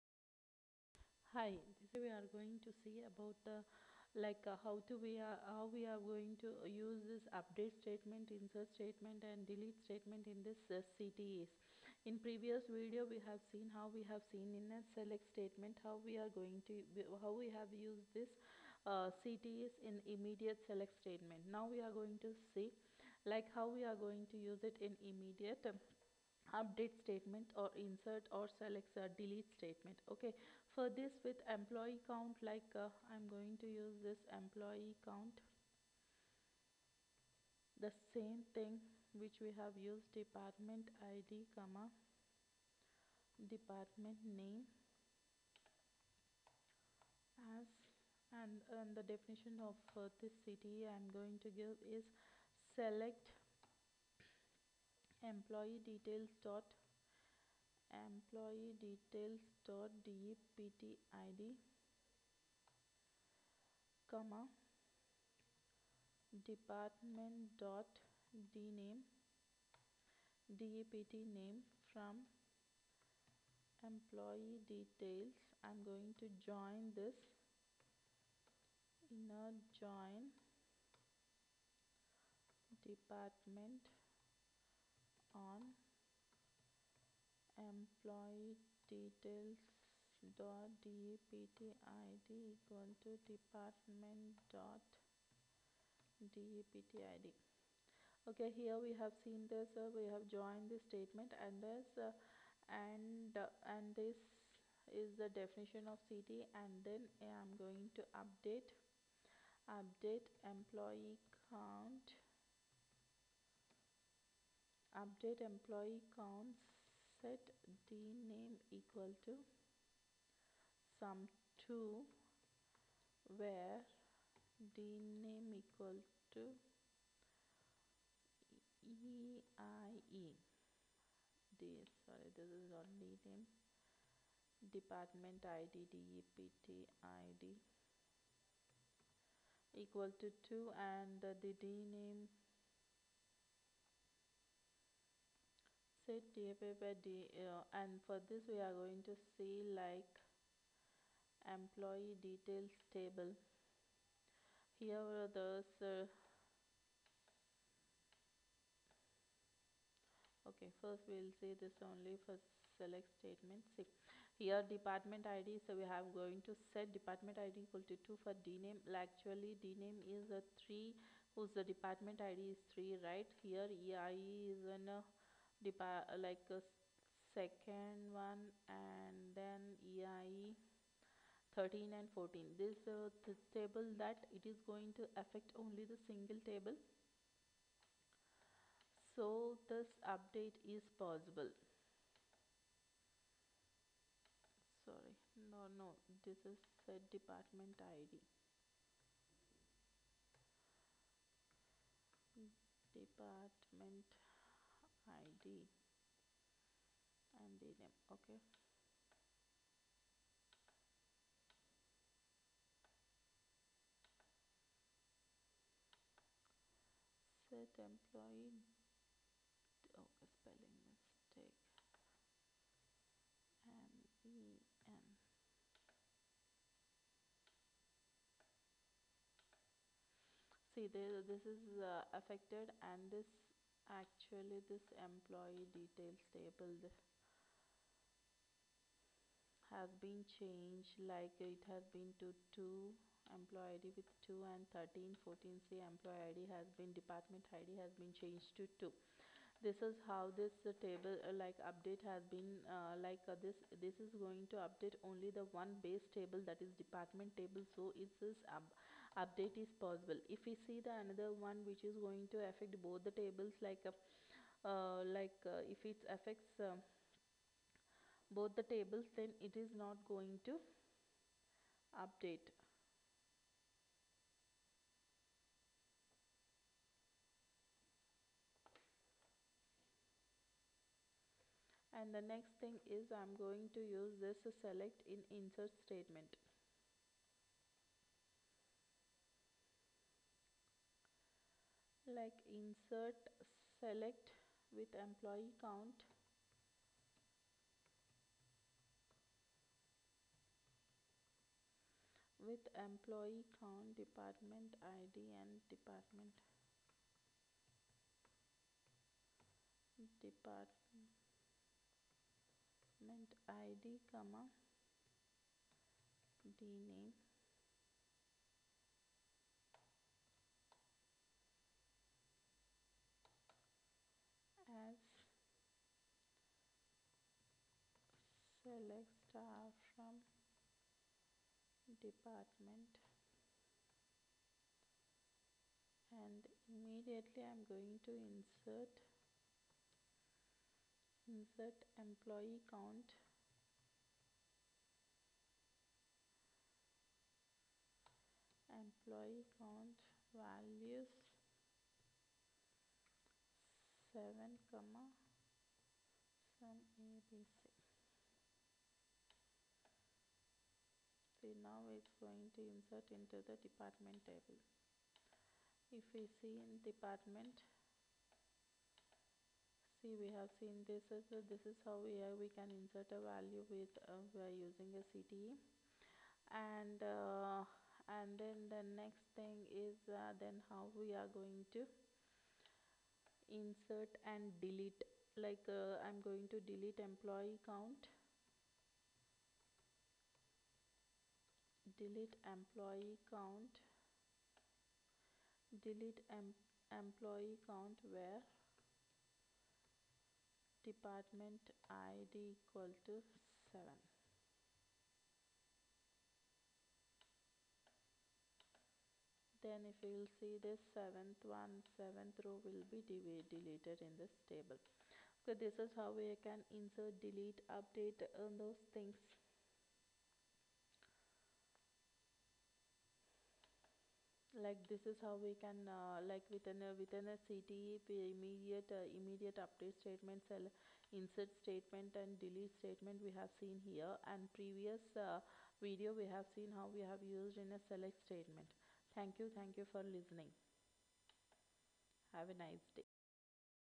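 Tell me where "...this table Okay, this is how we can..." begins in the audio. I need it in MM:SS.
06:54.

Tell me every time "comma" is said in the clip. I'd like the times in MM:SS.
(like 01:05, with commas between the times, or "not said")
00:41, 01:04, 05:14, 05:54.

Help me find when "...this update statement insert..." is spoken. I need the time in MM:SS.
00:07.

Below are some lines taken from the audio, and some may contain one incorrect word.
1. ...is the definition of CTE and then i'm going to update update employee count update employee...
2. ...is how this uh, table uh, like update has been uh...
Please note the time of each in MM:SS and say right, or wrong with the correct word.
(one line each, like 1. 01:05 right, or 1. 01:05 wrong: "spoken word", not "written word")
1. 01:45 right
2. 04:09 right.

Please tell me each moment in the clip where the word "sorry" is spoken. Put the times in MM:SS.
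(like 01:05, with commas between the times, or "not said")
02:12, 03:14.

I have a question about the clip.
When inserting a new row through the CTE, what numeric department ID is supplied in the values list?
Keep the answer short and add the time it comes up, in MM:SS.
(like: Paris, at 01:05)
7, at 05:50.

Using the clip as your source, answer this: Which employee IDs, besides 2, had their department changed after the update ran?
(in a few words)
13 and 14.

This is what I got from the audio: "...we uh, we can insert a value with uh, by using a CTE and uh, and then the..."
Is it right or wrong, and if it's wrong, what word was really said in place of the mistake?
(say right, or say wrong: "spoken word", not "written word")
right.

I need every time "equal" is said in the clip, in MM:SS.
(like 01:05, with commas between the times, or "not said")
01:32, 01:58, 02:05, 02:19, 02:47, 06:42.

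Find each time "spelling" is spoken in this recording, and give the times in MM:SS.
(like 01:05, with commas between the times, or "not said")
03:40.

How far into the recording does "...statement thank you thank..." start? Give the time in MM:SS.
07:18.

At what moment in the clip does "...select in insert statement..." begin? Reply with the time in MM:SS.
04:44.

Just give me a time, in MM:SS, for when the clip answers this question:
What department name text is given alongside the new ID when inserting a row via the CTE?
05:57.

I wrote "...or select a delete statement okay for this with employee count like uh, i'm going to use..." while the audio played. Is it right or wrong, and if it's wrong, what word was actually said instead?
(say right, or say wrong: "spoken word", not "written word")
right.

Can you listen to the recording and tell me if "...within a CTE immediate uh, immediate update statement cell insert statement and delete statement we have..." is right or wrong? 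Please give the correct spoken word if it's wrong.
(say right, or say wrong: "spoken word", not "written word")
right.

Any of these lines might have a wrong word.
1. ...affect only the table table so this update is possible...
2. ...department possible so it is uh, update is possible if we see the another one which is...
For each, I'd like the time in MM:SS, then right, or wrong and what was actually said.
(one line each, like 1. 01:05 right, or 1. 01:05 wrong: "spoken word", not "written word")
1. 03:05 wrong: "single", not "table"
2. 04:16 wrong: "table", not "possible".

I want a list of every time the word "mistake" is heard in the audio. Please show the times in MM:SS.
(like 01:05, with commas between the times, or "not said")
03:40.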